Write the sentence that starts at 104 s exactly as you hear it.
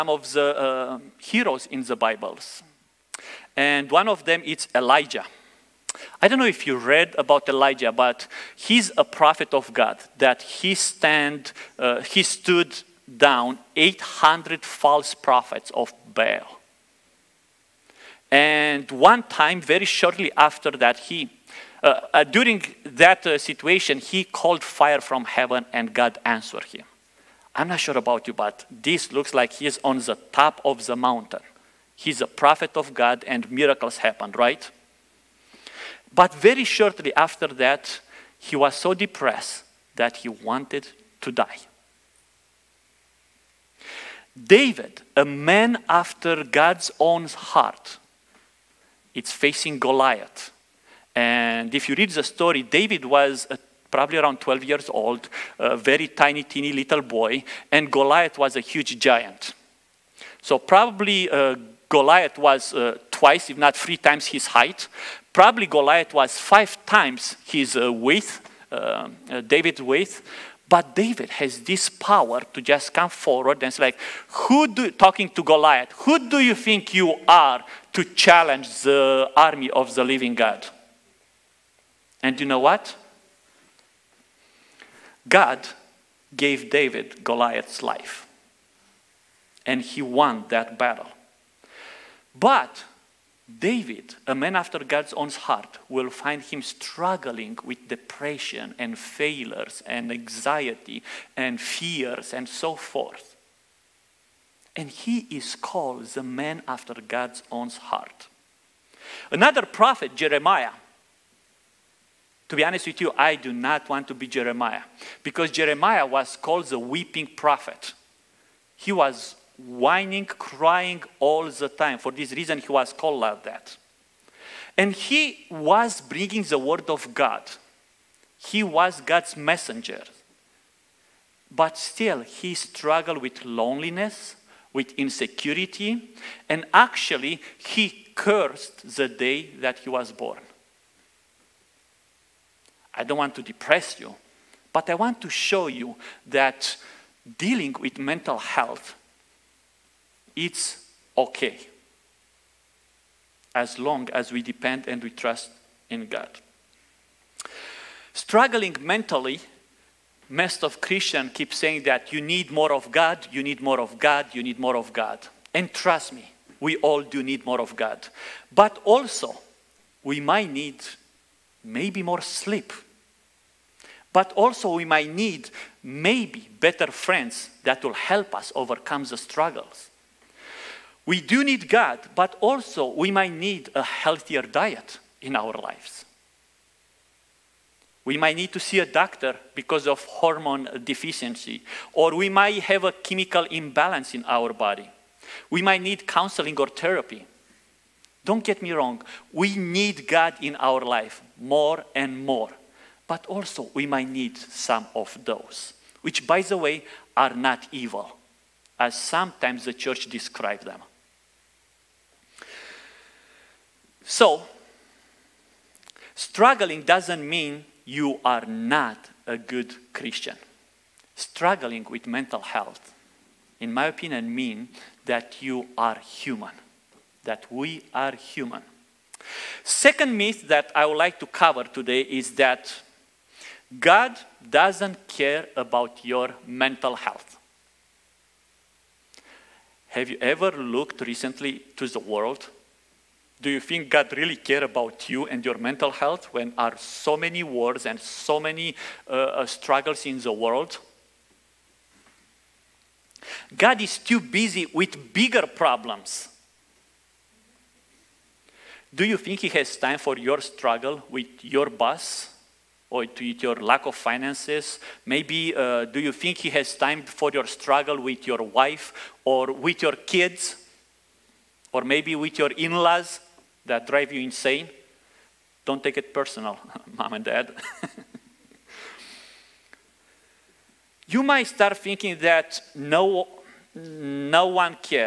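And he is called the man after God's own heart.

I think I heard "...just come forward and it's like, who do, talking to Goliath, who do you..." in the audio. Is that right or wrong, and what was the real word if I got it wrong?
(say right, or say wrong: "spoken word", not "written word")
right.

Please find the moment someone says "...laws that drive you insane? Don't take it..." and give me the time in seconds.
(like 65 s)
272 s.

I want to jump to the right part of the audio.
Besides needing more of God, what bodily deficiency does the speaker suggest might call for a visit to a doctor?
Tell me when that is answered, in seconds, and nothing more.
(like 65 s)
190 s.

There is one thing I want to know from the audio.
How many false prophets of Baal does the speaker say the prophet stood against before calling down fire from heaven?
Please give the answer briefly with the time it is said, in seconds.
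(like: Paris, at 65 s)
800, at 13 s.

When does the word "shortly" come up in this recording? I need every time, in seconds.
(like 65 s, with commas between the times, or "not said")
19 s, 36 s.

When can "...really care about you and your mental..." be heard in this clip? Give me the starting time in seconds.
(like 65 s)
244 s.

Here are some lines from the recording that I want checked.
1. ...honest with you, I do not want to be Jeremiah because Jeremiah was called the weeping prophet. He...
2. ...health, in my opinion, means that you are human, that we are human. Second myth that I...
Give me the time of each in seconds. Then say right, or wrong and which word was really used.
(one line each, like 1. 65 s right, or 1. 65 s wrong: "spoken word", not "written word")
1. 112 s right
2. 222 s right.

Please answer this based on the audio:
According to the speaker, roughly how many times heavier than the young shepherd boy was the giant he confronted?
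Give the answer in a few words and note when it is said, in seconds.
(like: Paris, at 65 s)
5 times, at 66 s.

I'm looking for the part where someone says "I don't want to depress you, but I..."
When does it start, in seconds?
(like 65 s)
142 s.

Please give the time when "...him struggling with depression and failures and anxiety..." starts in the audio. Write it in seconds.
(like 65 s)
96 s.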